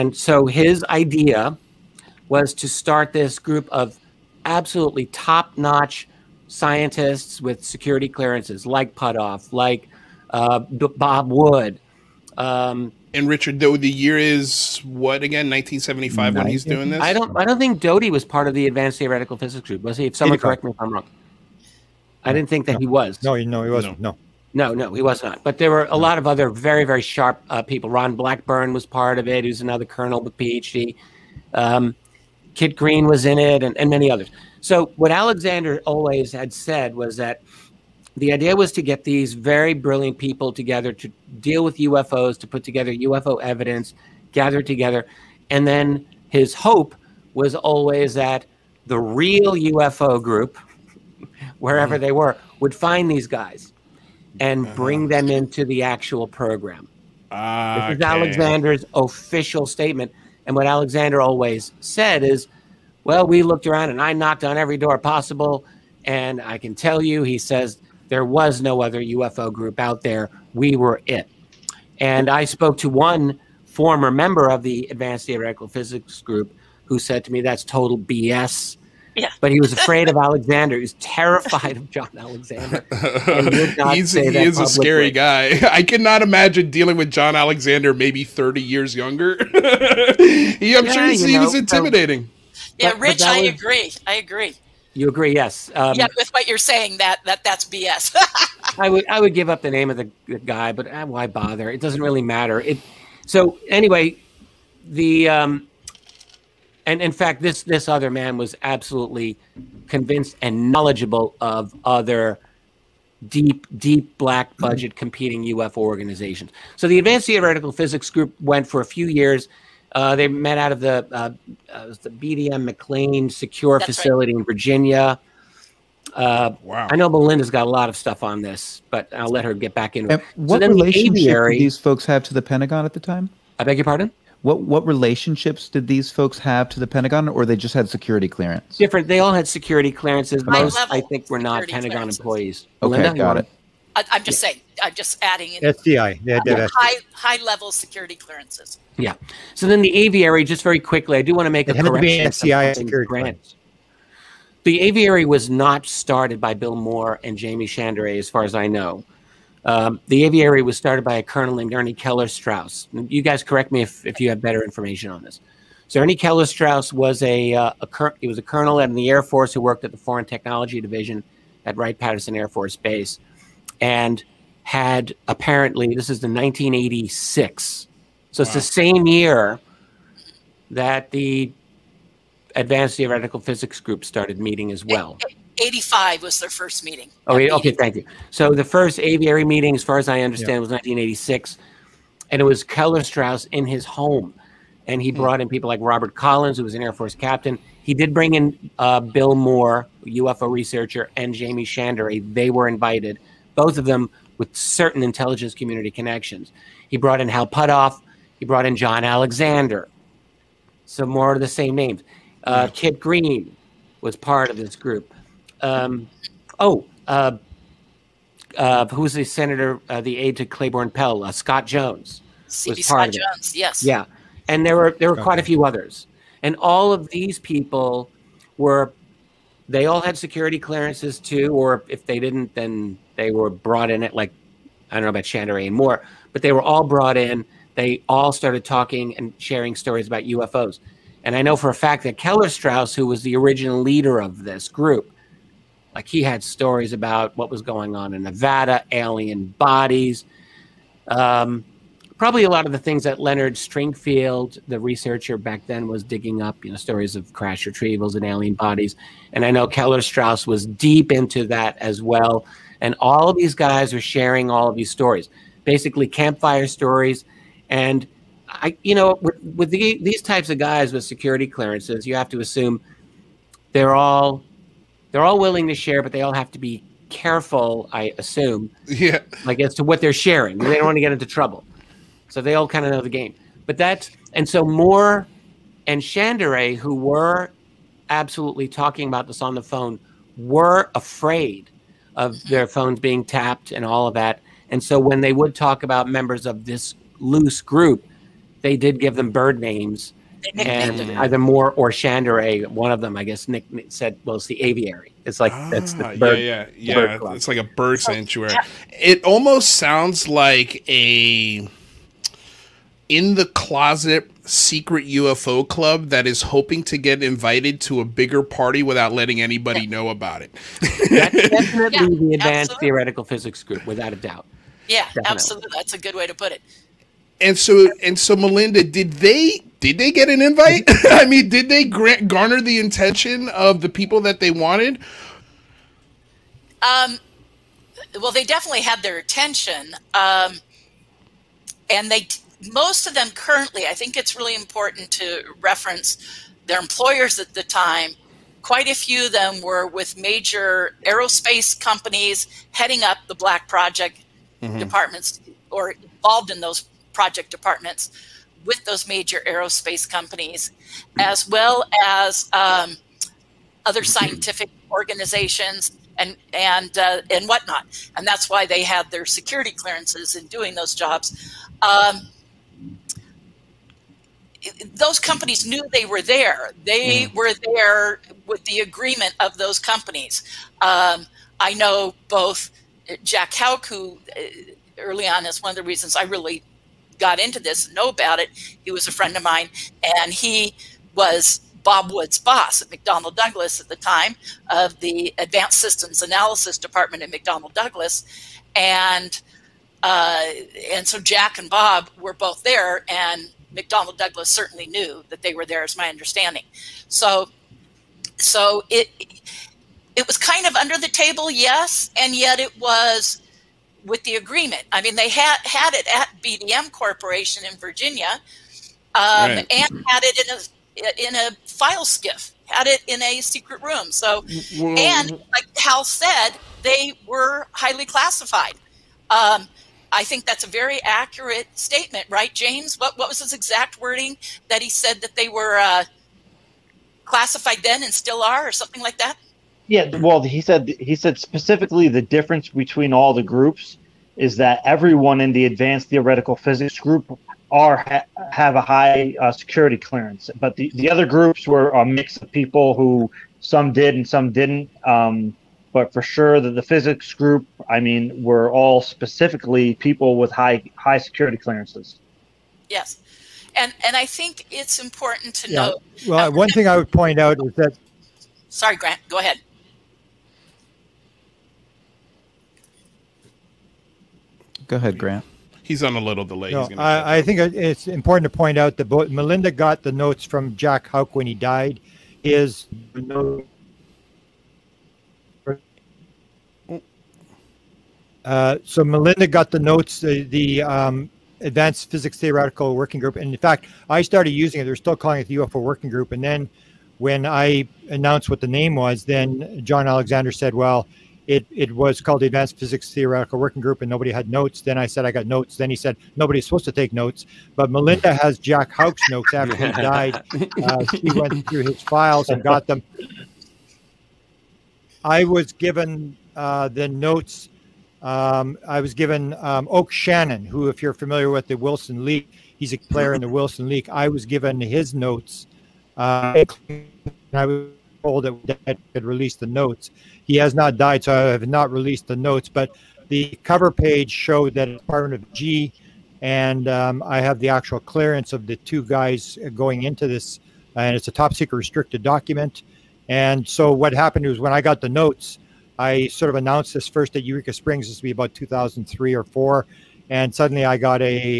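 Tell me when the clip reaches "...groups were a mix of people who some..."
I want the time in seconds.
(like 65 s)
451 s.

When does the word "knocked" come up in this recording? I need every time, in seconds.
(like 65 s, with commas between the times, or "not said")
64 s.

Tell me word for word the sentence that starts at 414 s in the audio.
I mean, they had had it at BDM Corporation in Virginia, um, right.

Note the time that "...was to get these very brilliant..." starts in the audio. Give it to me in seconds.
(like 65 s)
38 s.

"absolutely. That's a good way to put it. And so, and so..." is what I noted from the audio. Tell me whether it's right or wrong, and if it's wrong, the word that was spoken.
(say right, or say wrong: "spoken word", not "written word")
right.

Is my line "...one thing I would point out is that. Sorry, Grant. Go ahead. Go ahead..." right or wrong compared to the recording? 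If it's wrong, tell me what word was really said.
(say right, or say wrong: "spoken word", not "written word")
right.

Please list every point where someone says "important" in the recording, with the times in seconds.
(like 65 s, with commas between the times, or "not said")
344 s, 465 s, 478 s.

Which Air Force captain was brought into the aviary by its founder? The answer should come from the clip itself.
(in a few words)
Robert Collins.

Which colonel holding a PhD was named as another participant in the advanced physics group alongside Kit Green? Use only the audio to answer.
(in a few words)
Ron Blackburn.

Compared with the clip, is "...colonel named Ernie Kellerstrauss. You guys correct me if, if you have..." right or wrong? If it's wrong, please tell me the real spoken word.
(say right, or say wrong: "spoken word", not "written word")
right.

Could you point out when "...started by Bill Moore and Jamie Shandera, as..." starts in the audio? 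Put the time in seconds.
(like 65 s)
155 s.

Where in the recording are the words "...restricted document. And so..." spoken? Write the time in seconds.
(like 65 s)
541 s.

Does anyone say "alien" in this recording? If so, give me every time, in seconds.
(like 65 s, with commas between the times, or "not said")
248 s, 258 s.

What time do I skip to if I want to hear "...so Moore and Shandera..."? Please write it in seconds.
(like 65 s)
284 s.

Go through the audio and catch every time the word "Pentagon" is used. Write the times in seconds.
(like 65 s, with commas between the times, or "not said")
132 s, 136 s, 141 s.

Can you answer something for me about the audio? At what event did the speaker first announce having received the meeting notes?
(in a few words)
Eureka Springs.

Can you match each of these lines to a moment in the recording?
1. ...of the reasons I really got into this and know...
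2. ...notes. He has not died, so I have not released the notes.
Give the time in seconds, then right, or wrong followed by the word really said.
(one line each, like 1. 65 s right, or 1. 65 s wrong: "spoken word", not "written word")
1. 385 s right
2. 529 s right.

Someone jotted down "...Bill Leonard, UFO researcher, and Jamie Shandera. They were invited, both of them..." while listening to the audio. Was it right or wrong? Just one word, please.
wrong.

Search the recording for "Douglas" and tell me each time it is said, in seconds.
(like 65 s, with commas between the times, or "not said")
393 s, 397 s, 404 s.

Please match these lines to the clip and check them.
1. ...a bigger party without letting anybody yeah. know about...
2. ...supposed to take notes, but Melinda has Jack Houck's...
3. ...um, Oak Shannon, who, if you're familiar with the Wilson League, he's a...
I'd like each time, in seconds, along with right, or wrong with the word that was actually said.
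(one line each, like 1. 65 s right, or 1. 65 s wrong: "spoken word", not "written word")
1. 318 s right
2. 506 s right
3. 519 s right.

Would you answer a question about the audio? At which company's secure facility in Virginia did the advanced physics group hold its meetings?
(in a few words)
BDM McLean.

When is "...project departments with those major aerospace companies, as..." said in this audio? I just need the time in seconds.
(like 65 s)
357 s.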